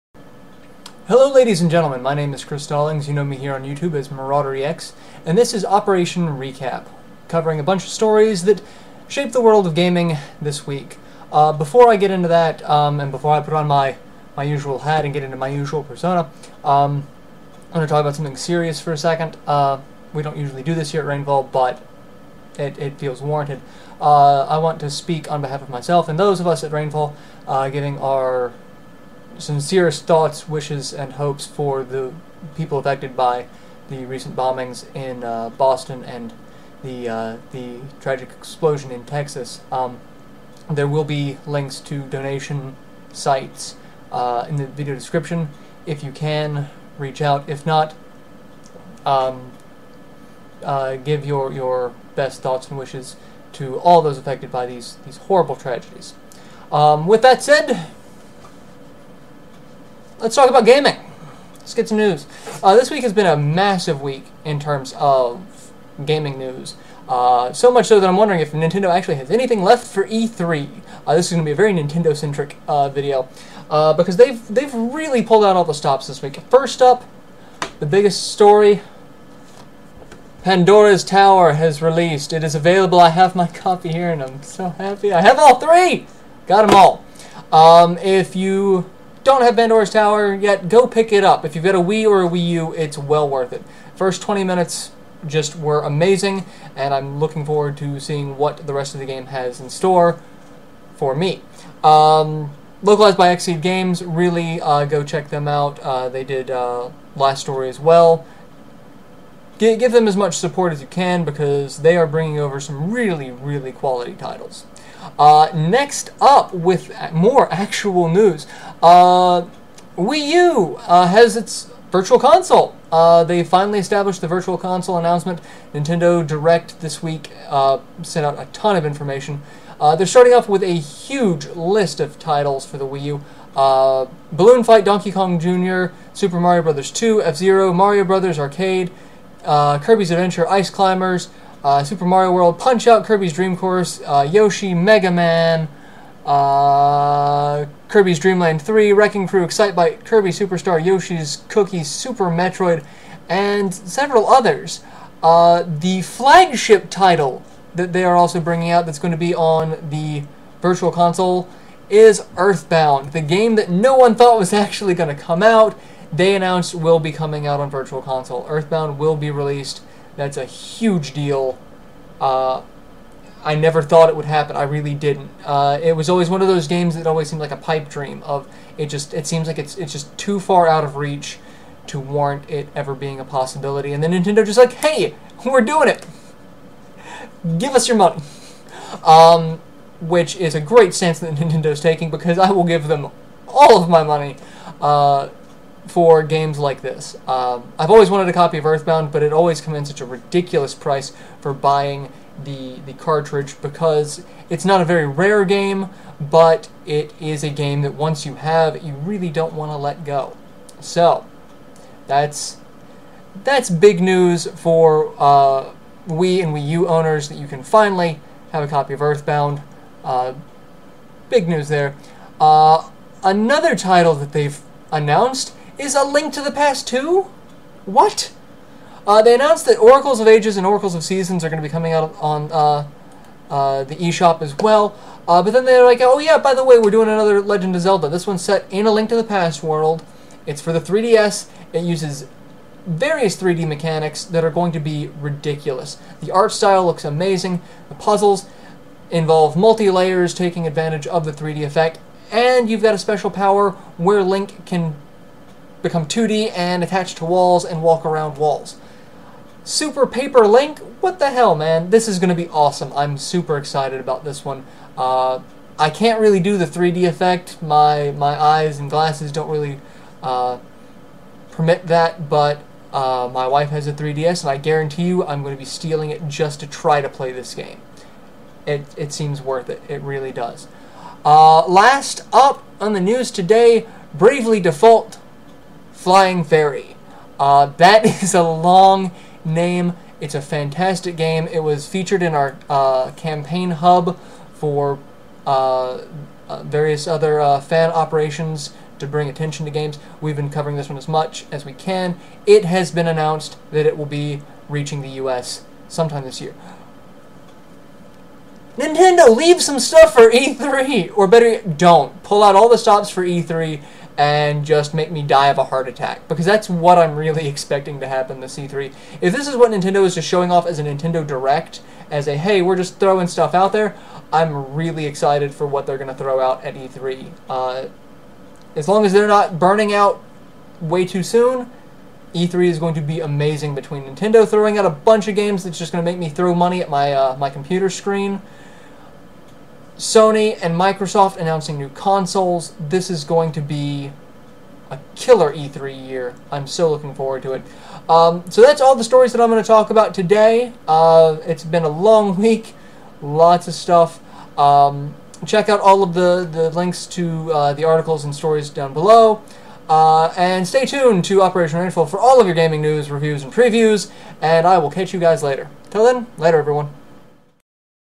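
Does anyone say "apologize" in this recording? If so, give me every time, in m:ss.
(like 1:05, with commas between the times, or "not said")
not said.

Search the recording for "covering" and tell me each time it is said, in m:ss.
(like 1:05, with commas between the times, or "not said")
0:07, 5:00.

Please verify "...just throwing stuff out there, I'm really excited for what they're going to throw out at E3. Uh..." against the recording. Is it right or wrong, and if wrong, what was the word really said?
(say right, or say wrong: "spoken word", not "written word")
right.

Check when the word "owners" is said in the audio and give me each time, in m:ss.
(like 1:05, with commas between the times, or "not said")
3:36.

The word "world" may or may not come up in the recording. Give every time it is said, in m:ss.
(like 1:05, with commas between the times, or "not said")
0:09, 2:22, 3:59.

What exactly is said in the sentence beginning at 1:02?
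Uh, this week has been a massive week in terms of gaming news.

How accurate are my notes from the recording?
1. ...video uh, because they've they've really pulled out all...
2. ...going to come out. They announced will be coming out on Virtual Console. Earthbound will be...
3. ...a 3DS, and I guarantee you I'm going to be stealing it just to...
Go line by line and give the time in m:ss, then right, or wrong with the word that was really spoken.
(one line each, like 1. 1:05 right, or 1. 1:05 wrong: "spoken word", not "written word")
1. 1:12 right
2. 2:44 right
3. 4:33 right.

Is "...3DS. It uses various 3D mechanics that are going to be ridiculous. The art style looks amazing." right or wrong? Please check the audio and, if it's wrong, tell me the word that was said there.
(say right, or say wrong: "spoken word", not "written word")
right.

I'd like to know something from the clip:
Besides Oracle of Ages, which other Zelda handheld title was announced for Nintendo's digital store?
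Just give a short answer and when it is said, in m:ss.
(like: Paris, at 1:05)
Oracles of Seasons, at 3:50.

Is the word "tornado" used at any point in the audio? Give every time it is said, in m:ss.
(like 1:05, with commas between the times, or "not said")
not said.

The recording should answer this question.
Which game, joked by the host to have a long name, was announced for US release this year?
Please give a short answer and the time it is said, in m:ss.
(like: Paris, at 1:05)
Bravely Default Flying Fairy, at 4:44.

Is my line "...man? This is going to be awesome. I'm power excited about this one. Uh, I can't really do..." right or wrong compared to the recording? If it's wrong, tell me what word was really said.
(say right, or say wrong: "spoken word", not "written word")
wrong: "super", not "power".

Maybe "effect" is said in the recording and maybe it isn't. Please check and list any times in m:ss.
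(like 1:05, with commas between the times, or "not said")
4:11, 4:27.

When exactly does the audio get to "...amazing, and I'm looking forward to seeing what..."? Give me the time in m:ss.
1:35.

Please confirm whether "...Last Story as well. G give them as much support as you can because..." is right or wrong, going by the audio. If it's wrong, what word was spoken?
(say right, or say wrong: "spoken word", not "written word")
right.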